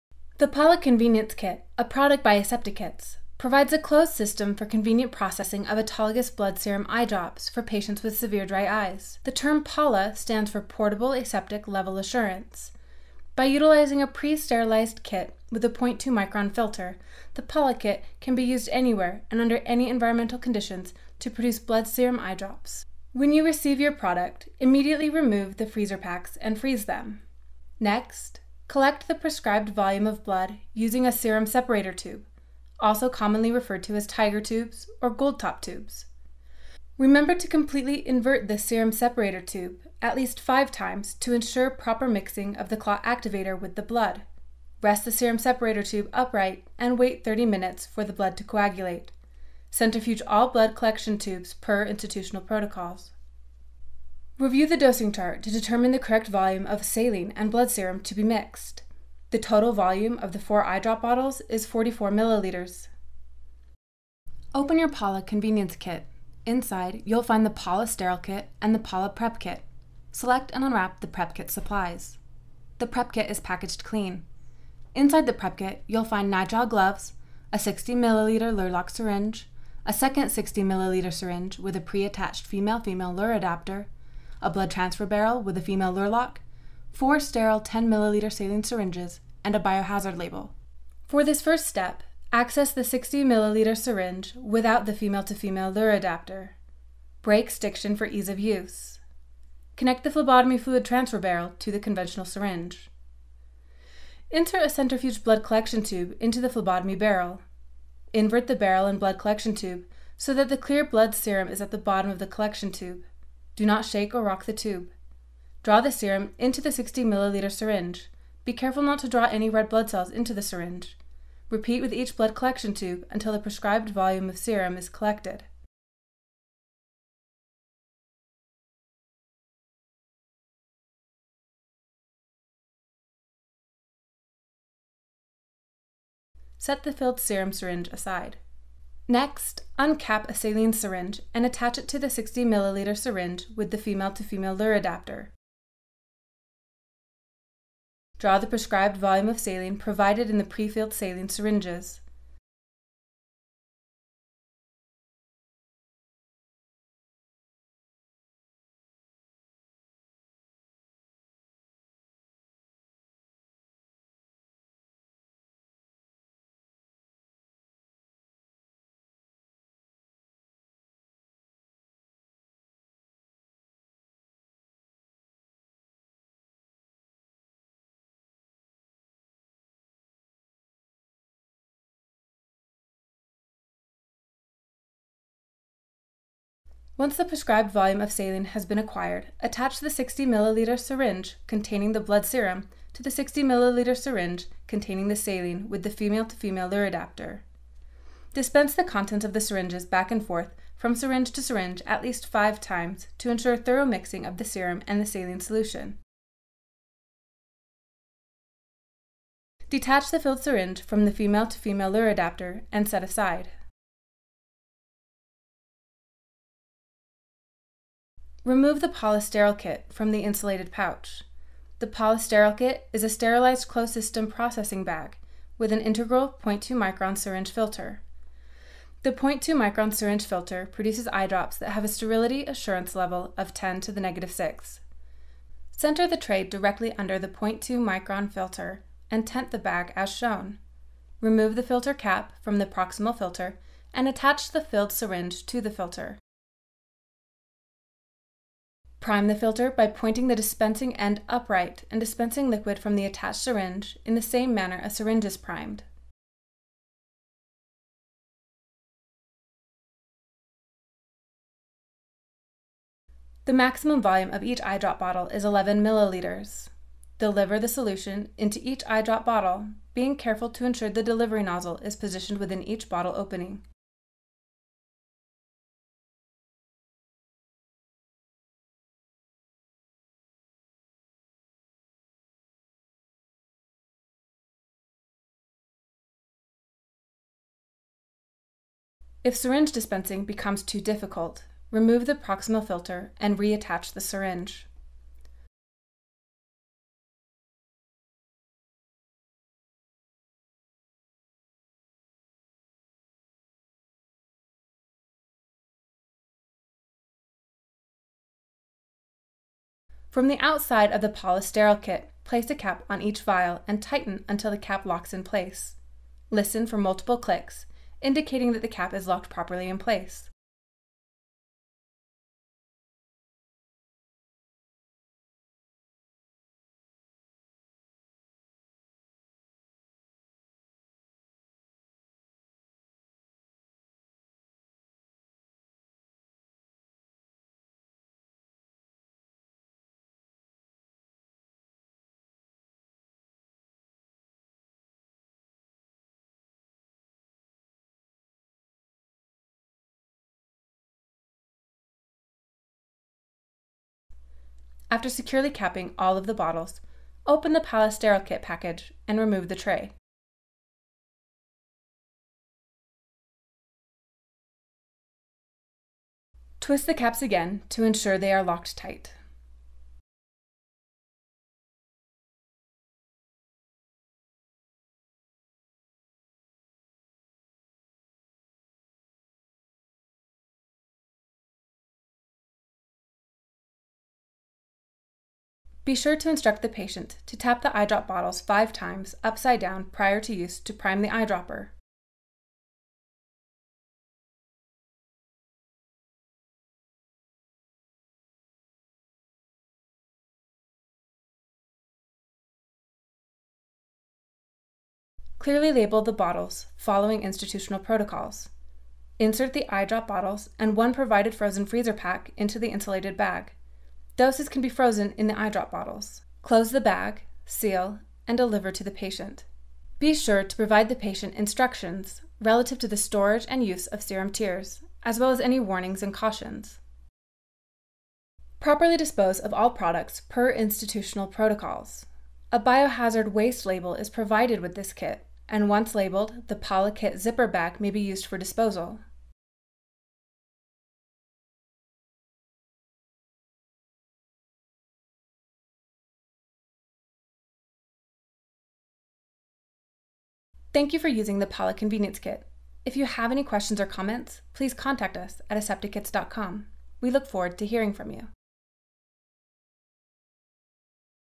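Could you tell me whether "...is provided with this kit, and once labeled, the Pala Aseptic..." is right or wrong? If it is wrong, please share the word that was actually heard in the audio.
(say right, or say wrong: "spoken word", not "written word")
wrong: "Kit", not "Aseptic".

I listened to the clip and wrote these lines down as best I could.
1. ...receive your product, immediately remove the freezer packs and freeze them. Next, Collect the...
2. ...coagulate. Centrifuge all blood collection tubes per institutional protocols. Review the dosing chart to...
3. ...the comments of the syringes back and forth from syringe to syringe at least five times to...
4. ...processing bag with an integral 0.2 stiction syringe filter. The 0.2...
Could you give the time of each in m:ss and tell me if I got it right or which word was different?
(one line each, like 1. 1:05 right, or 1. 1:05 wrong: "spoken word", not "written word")
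1. 0:23 right
2. 0:48 right
3. 3:18 wrong: "contents", not "comments"
4. 3:44 wrong: "micron", not "stiction".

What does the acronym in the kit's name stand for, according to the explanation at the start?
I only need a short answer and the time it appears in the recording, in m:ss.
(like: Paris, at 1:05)
Portable Aseptic Level Assurance, at 0:10.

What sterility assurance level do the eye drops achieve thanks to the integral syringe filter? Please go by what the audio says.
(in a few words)
10 to the negative 6.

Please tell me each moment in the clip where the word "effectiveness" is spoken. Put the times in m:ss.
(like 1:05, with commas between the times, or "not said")
not said.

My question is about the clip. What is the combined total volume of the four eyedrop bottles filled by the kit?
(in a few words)
44 milliliters.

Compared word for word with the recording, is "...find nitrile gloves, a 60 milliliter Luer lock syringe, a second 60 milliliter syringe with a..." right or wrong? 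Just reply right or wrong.
right.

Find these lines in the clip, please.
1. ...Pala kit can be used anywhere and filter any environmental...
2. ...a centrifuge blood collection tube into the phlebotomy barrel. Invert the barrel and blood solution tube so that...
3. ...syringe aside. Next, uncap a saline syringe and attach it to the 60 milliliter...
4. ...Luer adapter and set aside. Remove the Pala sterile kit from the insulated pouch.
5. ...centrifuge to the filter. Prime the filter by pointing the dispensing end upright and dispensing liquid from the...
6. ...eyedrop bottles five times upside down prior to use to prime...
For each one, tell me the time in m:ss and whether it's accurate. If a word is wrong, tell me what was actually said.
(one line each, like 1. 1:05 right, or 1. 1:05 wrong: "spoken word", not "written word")
1. 0:17 wrong: "under", not "filter"
2. 1:44 wrong: "collection", not "solution"
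3. 2:17 right
4. 3:31 right
5. 4:04 wrong: "syringe", not "centrifuge"
6. 6:27 right.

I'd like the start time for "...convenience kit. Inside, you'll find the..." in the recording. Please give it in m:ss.
1:05.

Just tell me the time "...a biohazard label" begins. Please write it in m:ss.
1:29.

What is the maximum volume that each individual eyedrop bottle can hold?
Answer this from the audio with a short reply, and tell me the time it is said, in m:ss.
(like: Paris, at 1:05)
11 milliliters, at 4:25.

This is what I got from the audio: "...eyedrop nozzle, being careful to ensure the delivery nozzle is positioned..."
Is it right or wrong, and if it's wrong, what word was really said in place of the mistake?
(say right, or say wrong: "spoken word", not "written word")
wrong: "bottle", not "nozzle".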